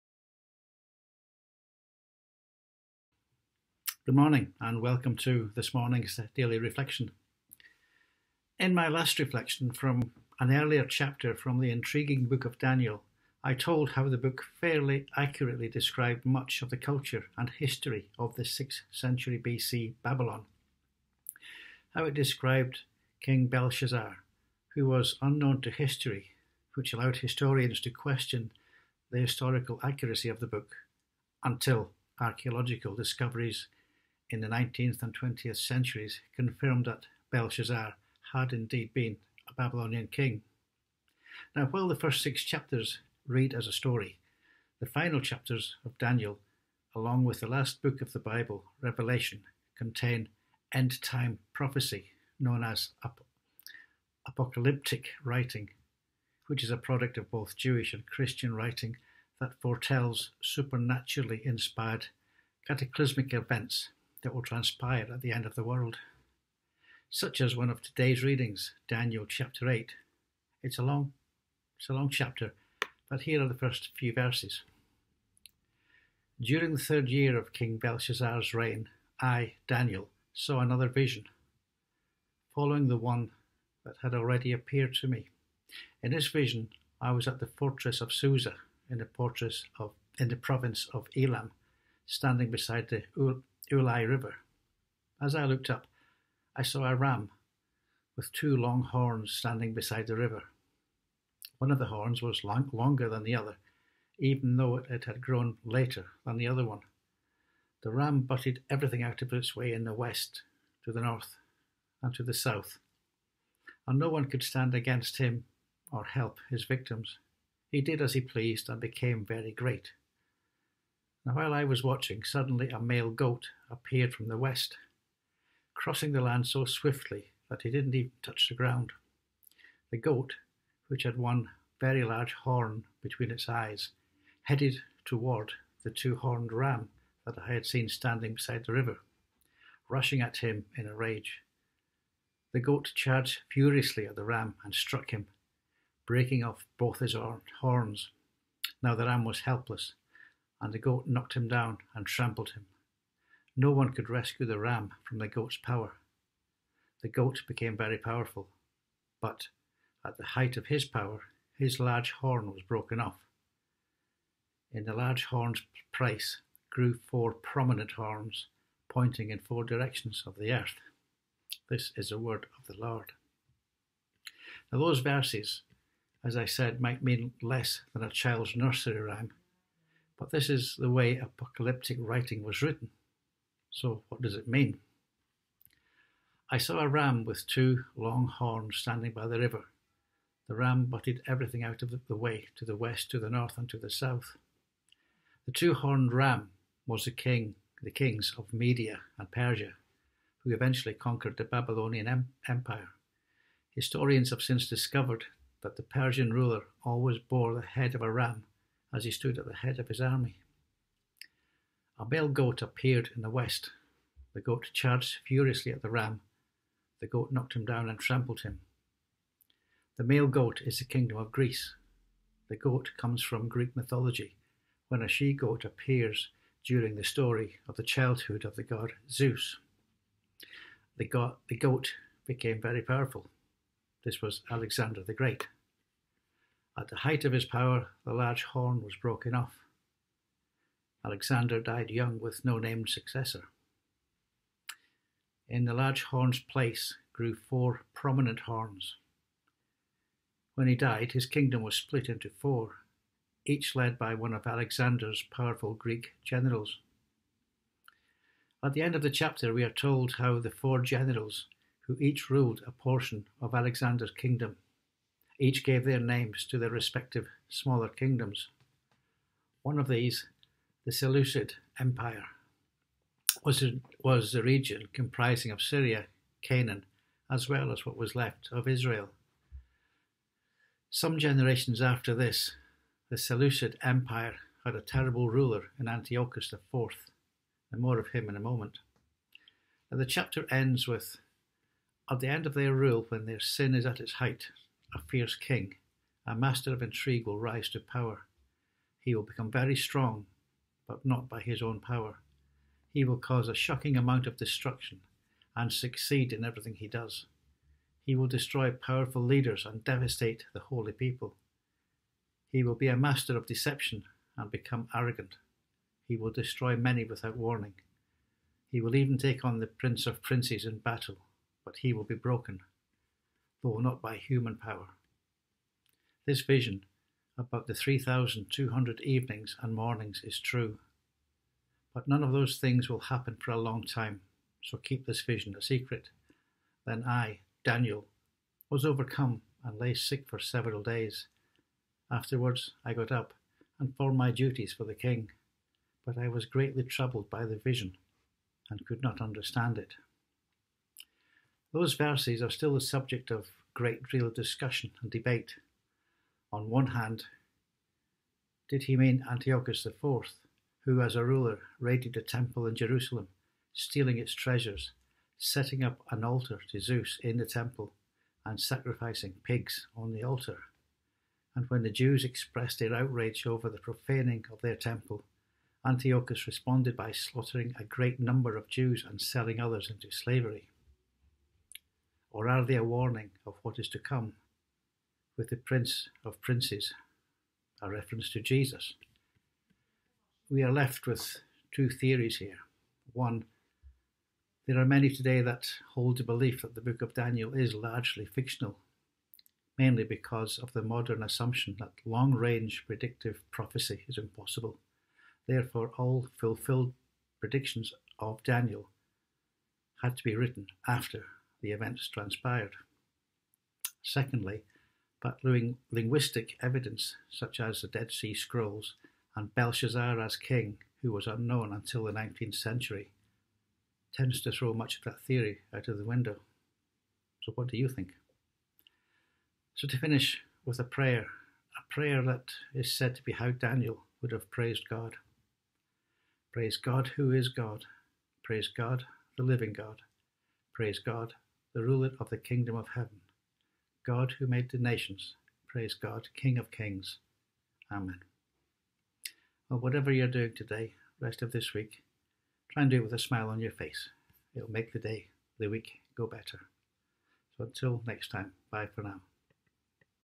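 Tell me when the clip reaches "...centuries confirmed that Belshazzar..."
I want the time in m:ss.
0:35.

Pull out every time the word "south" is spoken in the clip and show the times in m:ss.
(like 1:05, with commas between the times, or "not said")
1:52, 3:13.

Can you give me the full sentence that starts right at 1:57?
He did as he pleased and became very great.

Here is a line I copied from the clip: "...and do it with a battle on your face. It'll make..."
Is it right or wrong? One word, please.
wrong.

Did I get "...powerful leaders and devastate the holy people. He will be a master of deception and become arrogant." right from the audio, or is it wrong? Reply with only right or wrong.
right.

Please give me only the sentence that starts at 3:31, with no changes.
A bell goat appeared in the west.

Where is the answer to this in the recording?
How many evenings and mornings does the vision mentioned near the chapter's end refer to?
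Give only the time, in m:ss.
5:27.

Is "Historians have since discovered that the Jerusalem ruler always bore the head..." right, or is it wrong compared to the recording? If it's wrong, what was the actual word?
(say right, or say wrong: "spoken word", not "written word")
wrong: "Persian", not "Jerusalem".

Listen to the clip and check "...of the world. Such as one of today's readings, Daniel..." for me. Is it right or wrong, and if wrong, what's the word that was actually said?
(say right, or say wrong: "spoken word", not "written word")
right.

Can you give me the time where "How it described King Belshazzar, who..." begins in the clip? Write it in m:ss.
0:21.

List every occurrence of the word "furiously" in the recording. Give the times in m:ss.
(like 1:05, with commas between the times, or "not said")
2:23, 3:35.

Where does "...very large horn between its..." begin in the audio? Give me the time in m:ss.
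2:11.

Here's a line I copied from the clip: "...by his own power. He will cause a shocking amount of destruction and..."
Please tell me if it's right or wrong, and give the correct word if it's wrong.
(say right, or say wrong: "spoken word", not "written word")
right.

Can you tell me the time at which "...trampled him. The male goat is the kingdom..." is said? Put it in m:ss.
3:37.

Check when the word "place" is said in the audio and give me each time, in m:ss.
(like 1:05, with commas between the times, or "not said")
2:45, 4:06.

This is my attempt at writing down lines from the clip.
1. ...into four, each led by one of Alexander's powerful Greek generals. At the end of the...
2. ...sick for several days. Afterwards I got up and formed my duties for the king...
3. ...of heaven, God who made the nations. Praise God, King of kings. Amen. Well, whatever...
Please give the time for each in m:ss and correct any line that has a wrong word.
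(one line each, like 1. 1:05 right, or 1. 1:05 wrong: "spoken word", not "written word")
1. 4:12 right
2. 5:39 right
3. 7:22 right.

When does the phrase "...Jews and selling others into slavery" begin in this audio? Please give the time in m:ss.
6:18.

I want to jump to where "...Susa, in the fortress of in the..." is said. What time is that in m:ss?
1:28.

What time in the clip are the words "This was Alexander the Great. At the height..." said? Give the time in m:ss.
3:54.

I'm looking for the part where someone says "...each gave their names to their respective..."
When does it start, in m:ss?
4:25.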